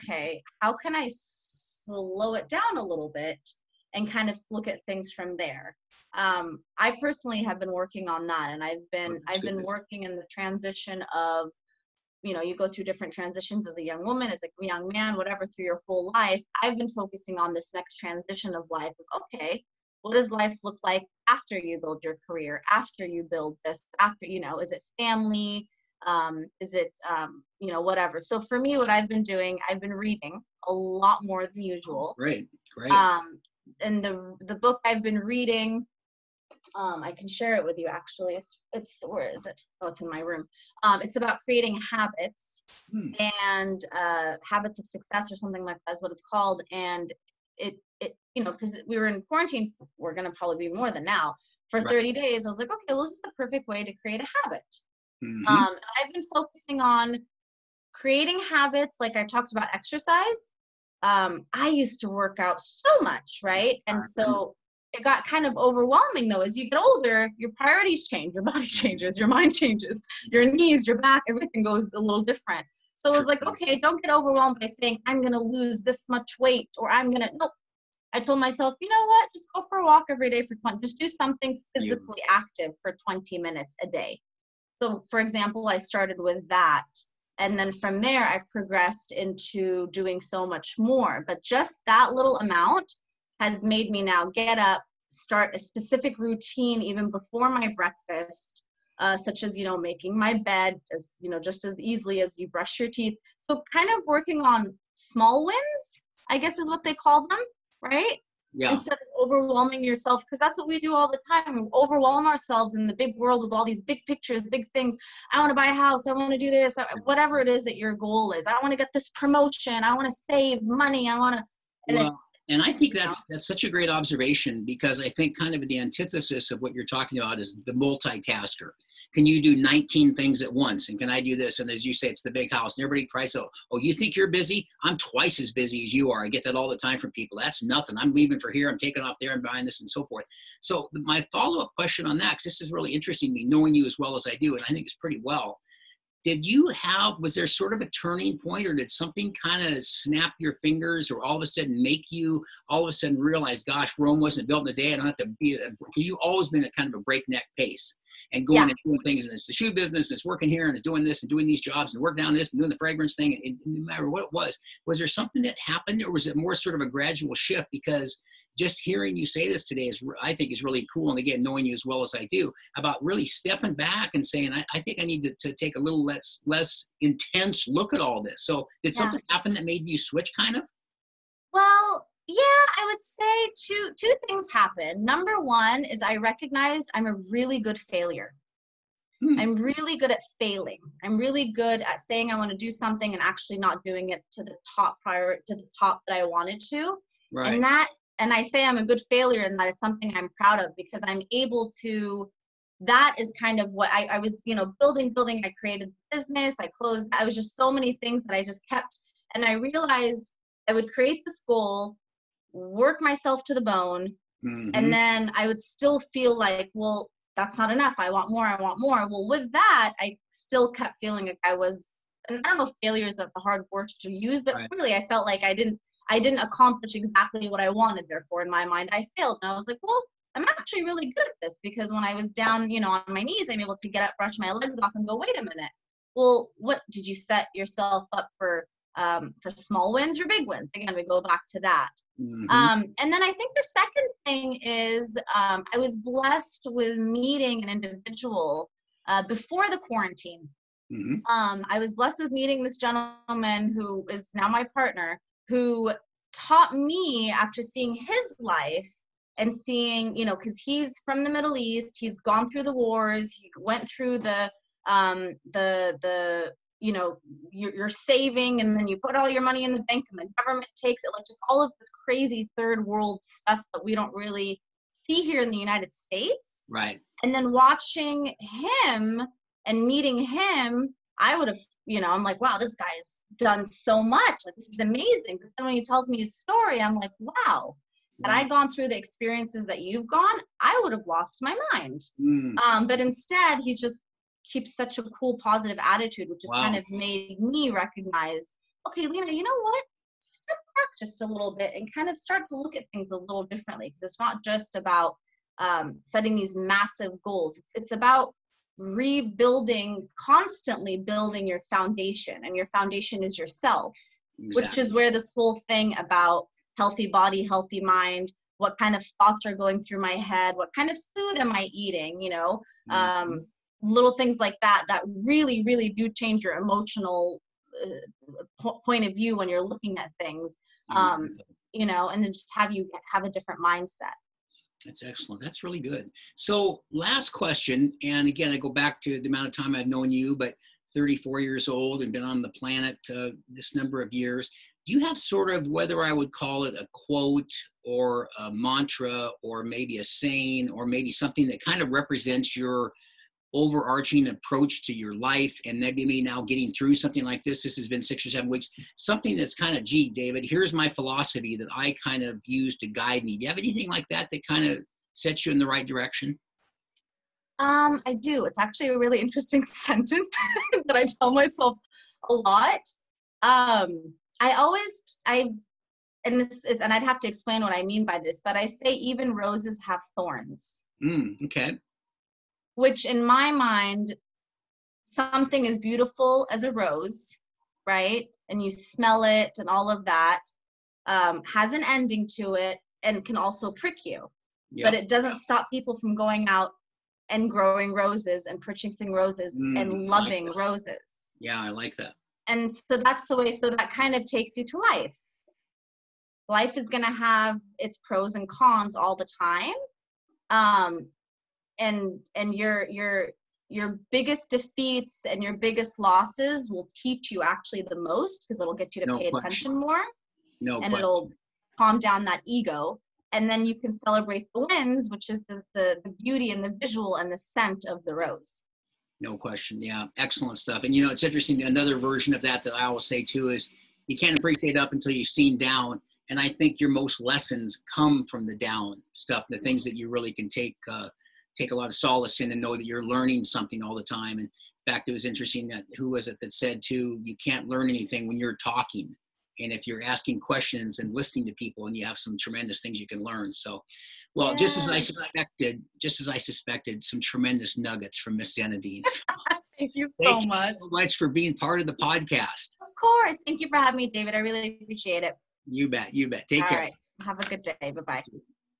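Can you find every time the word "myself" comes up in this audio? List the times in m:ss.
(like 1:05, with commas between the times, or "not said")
1:18, 3:33, 6:11.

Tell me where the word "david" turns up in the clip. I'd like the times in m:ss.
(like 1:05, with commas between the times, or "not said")
6:00, 7:44.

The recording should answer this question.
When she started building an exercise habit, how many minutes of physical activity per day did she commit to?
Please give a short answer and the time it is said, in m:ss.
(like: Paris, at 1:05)
20, at 1:23.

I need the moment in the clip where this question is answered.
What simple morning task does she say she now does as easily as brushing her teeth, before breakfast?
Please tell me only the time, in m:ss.
1:39.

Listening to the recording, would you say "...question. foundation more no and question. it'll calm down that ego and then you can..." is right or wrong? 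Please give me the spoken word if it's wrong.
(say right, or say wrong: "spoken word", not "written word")
wrong: "attention", not "foundation".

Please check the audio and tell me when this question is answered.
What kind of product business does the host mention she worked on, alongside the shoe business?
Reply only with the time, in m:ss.
2:42.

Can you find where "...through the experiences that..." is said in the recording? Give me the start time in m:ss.
4:48.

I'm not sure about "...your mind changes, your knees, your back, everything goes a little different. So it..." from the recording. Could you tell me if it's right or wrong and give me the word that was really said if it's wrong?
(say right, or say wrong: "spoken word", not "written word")
right.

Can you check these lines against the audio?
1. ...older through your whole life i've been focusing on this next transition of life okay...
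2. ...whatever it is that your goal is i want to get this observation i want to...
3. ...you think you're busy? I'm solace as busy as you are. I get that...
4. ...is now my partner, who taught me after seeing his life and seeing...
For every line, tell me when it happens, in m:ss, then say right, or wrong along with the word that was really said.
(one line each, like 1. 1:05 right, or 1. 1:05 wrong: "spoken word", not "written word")
1. 0:15 wrong: "whatever", not "older"
2. 1:57 wrong: "promotion", not "observation"
3. 2:13 wrong: "twice", not "solace"
4. 4:14 right.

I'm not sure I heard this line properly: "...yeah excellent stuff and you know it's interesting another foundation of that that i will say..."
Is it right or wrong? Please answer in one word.
wrong.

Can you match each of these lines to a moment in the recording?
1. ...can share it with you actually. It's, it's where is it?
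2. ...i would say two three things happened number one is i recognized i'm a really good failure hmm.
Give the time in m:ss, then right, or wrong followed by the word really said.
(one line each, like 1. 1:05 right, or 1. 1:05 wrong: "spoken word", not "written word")
1. 0:37 right
2. 3:02 wrong: "two", not "three".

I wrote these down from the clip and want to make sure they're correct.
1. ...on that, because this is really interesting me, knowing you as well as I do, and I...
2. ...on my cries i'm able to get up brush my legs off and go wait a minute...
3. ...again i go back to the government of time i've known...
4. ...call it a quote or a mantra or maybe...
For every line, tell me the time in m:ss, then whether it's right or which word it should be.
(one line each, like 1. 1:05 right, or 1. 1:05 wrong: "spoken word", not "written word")
1. 2:22 right
2. 3:52 wrong: "knees", not "cries"
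3. 5:38 wrong: "amount", not "government"
4. 5:46 right.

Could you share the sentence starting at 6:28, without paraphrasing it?
And you smell it and all of that um, has an ending to it and can also prick you.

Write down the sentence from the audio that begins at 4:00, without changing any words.
Again, we go back to that.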